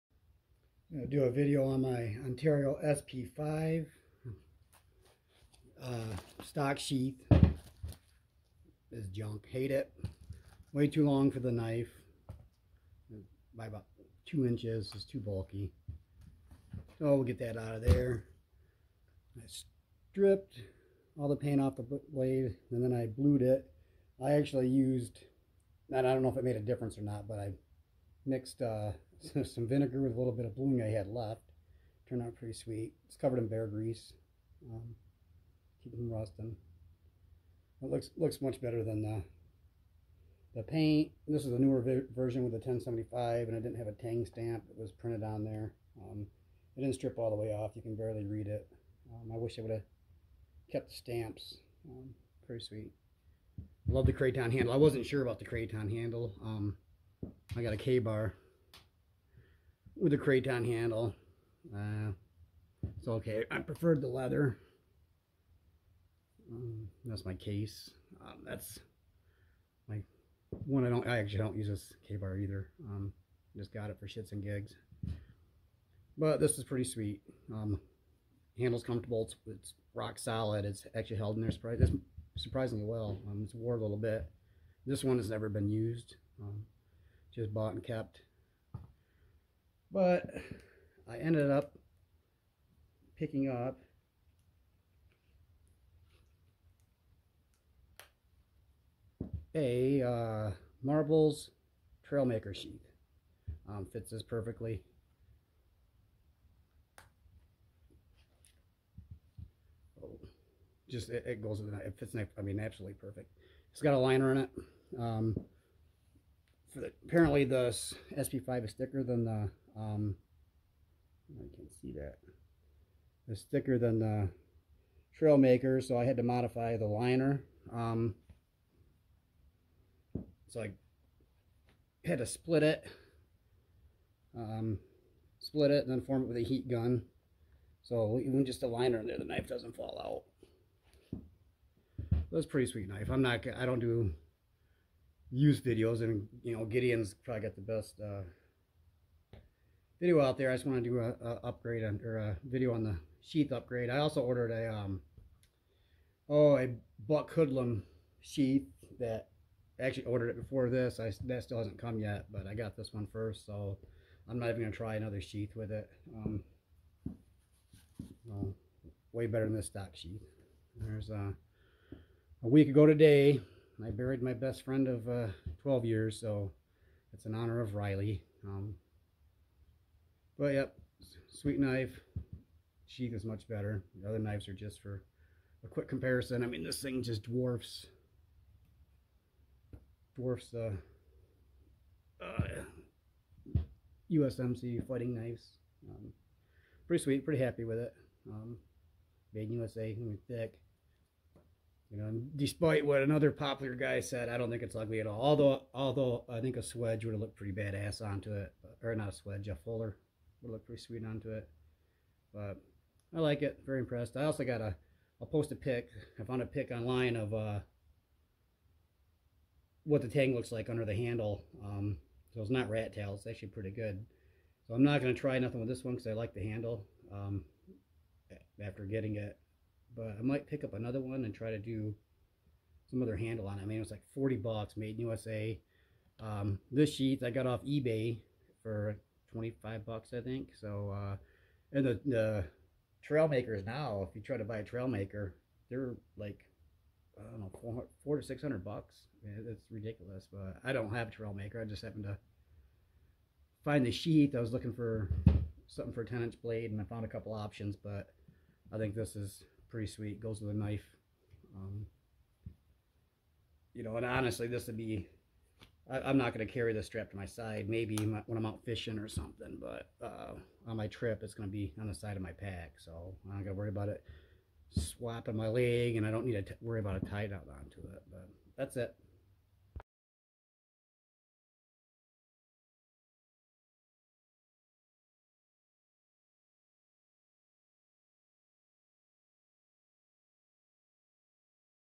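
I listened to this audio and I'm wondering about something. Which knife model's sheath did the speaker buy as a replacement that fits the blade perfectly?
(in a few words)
Marbles Trailmaker.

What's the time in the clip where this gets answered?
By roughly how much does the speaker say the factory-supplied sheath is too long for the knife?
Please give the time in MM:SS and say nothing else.
00:13.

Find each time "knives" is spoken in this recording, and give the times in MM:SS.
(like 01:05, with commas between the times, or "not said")
03:04, 03:15.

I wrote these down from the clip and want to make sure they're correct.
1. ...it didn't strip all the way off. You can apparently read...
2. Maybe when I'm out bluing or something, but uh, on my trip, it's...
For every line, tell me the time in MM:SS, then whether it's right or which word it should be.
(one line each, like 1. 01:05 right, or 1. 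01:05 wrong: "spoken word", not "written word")
1. 00:46 wrong: "barely", not "apparently"
2. 04:27 wrong: "fishing", not "bluing".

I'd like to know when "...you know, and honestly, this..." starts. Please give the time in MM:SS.
04:23.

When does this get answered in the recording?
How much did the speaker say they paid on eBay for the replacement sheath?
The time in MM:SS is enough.
03:59.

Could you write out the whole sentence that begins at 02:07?
Um, so I had to split it, um, split it, and then form it with a heat gun.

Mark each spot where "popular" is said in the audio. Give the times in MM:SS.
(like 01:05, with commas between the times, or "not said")
03:23.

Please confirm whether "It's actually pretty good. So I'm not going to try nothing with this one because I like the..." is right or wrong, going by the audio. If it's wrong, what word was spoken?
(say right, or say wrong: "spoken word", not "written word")
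right.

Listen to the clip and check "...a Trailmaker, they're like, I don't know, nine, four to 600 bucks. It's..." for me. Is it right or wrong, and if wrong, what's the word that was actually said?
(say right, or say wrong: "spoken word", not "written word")
wrong: "four", not "nine".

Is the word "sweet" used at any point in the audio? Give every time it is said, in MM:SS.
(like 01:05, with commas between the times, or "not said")
00:32, 00:52, 01:16, 02:22, 03:01, 03:17, 03:30, 04:19.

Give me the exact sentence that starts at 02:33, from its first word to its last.
I also ordered a um, oh a buck hoodlum sheath that actually ordered it before this.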